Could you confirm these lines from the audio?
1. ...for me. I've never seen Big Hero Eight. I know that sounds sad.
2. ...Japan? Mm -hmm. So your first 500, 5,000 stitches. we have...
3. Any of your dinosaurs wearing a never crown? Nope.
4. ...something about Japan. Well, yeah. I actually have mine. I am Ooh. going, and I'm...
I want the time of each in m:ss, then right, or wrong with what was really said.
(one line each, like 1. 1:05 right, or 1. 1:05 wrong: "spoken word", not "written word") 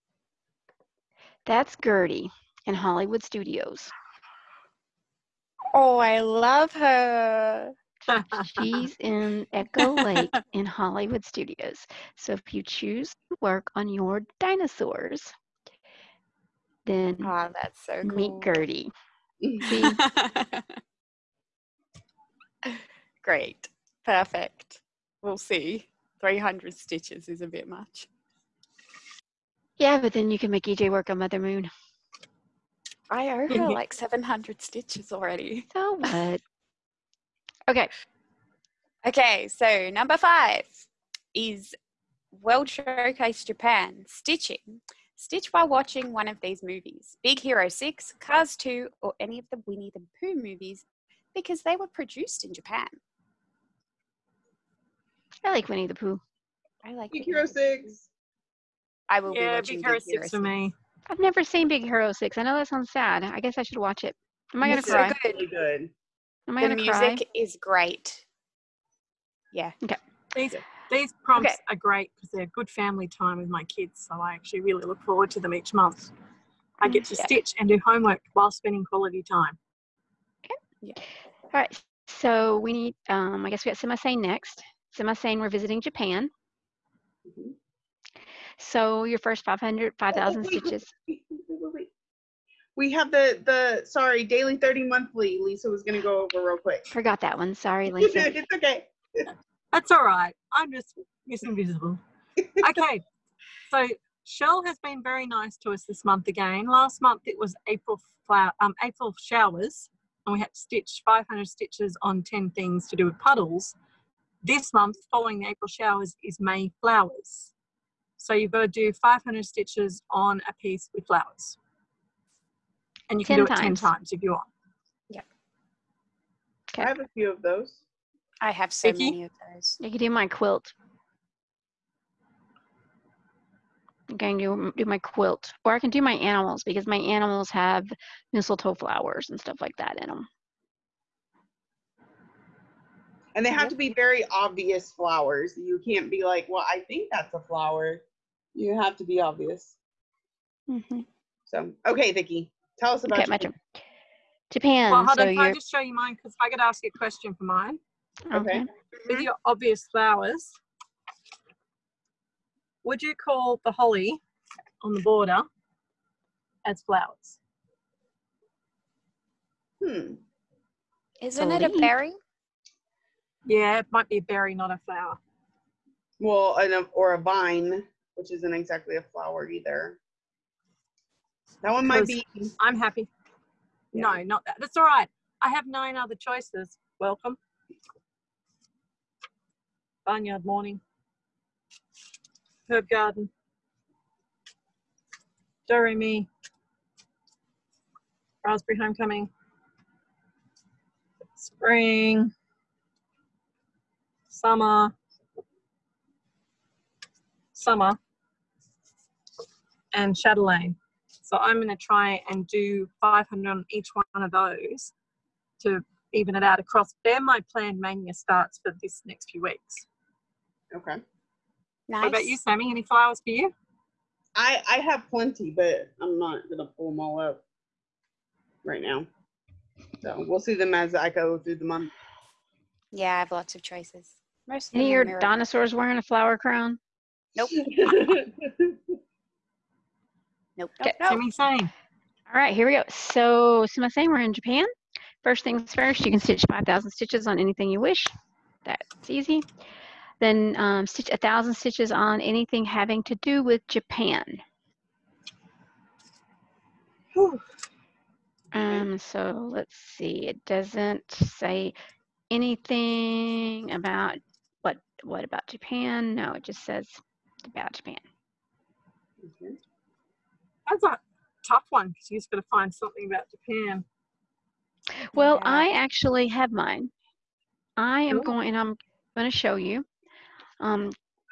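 1. 1:00 wrong: "Six", not "Eight"
2. 1:25 right
3. 3:54 wrong: "flower", not "never"
4. 4:32 right.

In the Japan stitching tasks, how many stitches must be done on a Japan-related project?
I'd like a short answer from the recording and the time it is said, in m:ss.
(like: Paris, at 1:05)
1,000, at 4:11.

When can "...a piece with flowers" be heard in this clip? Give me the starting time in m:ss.
2:00.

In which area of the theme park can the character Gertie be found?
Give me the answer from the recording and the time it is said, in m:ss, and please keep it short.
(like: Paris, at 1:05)
Echo Lake, at 0:09.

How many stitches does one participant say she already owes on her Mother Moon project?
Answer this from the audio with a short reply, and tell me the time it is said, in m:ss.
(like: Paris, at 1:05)
700, at 0:33.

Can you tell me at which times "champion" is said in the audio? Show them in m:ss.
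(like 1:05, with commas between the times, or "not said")
not said.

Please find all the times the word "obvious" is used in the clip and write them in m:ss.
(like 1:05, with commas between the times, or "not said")
2:24, 2:29, 2:39.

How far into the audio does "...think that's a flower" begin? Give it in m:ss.
2:26.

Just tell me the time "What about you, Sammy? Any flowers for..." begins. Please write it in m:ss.
3:42.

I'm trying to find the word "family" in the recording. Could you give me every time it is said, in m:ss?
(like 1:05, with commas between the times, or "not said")
1:12.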